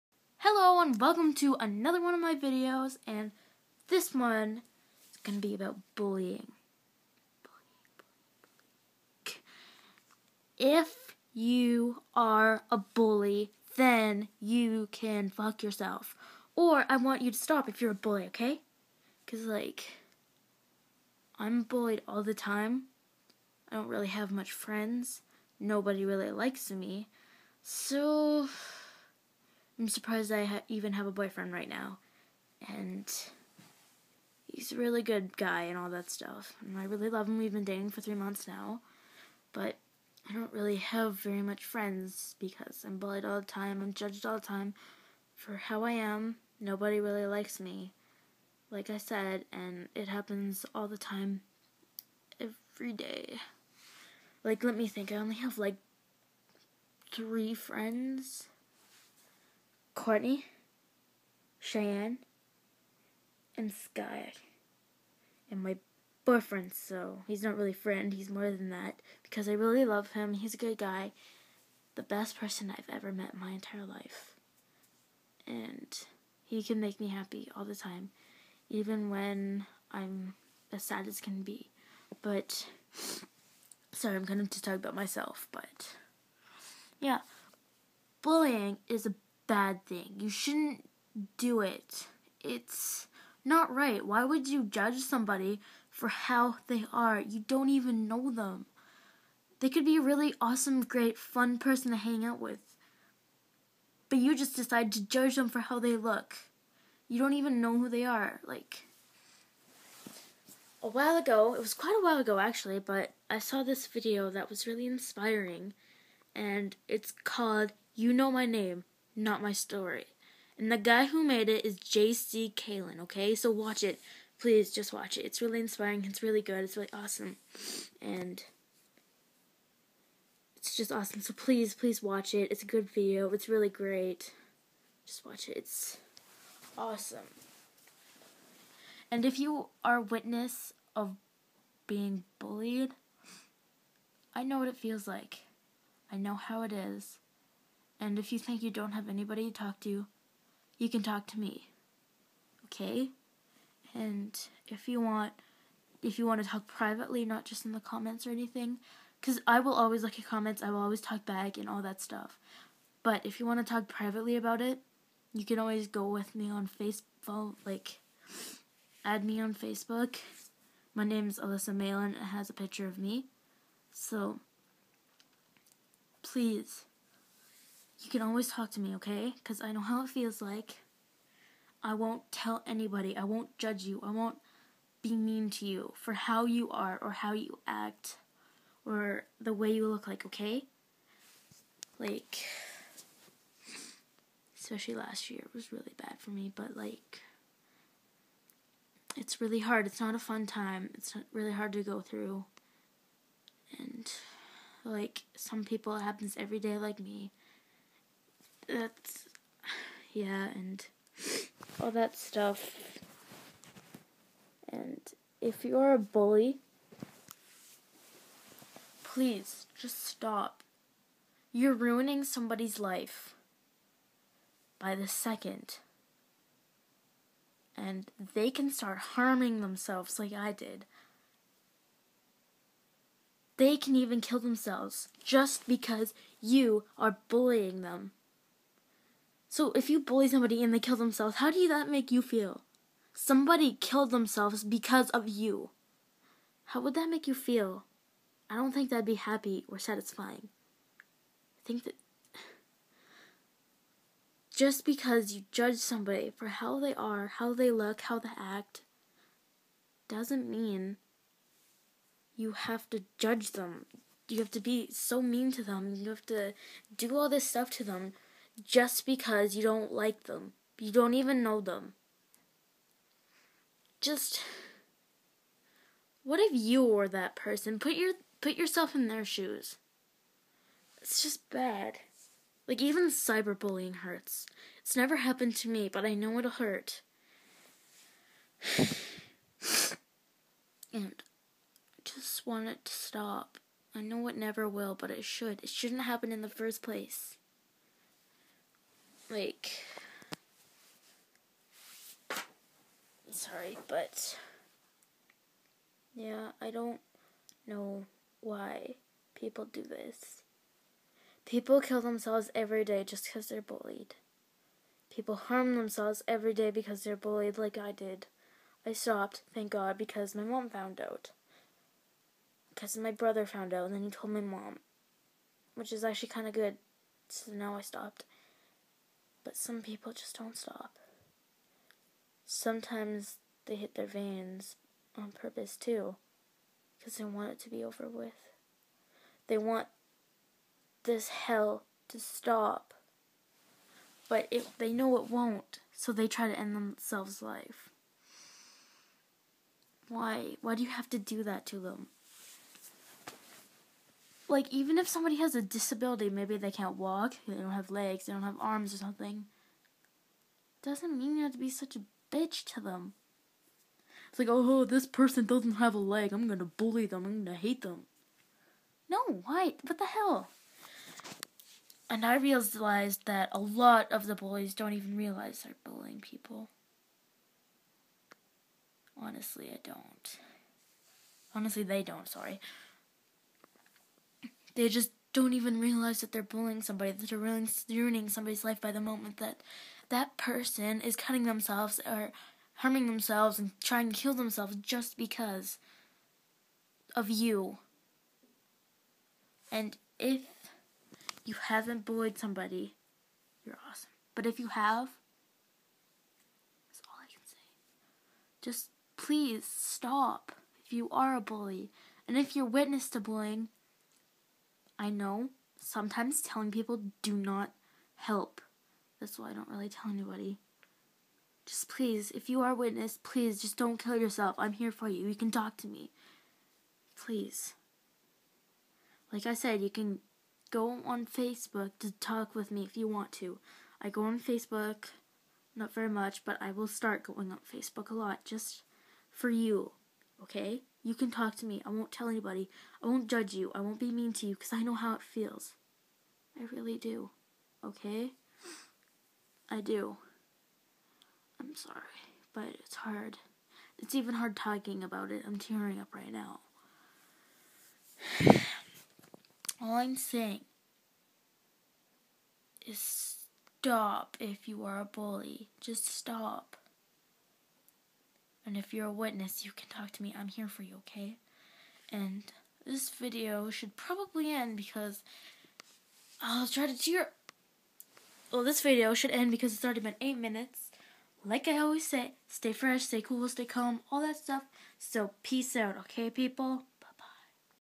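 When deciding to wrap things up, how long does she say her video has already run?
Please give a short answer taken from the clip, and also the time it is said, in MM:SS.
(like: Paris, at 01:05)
8 minutes, at 08:00.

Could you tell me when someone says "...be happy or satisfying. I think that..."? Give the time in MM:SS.
04:09.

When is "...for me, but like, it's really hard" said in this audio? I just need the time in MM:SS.
03:16.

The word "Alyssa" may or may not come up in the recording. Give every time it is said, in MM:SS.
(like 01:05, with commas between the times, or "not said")
02:51.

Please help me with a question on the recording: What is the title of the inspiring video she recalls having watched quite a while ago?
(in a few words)
You Know My Name not my story.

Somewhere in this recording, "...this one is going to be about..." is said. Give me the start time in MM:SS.
00:03.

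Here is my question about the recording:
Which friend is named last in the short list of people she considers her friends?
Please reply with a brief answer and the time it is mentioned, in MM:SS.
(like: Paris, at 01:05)
Sky, at 01:03.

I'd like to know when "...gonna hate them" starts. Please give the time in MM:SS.
06:07.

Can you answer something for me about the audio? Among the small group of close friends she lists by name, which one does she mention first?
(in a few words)
Courtney.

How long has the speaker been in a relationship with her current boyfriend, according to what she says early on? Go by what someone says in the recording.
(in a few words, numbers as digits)
3 months.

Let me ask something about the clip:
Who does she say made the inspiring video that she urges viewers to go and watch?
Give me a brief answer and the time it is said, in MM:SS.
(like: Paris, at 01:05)
J.C. 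Kalen, at 02:01.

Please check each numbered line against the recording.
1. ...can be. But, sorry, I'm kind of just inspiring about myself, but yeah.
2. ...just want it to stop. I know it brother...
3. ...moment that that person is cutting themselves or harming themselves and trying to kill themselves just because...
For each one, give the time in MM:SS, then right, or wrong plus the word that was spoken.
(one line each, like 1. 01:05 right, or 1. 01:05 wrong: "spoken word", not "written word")
1. 01:21 wrong: "talking", not "inspiring"
2. 04:52 wrong: "never", not "brother"
3. 06:29 right.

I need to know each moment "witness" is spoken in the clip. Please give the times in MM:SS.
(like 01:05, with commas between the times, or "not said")
02:19, 06:52, 07:02, 07:49.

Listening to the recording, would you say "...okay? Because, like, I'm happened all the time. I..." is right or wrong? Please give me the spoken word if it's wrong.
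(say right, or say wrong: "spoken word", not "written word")
wrong: "bullied", not "happened".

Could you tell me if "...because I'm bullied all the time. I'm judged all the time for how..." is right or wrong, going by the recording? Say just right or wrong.
right.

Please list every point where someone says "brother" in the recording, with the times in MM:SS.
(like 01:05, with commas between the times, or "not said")
05:23.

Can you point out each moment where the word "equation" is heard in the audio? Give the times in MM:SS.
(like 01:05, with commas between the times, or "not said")
not said.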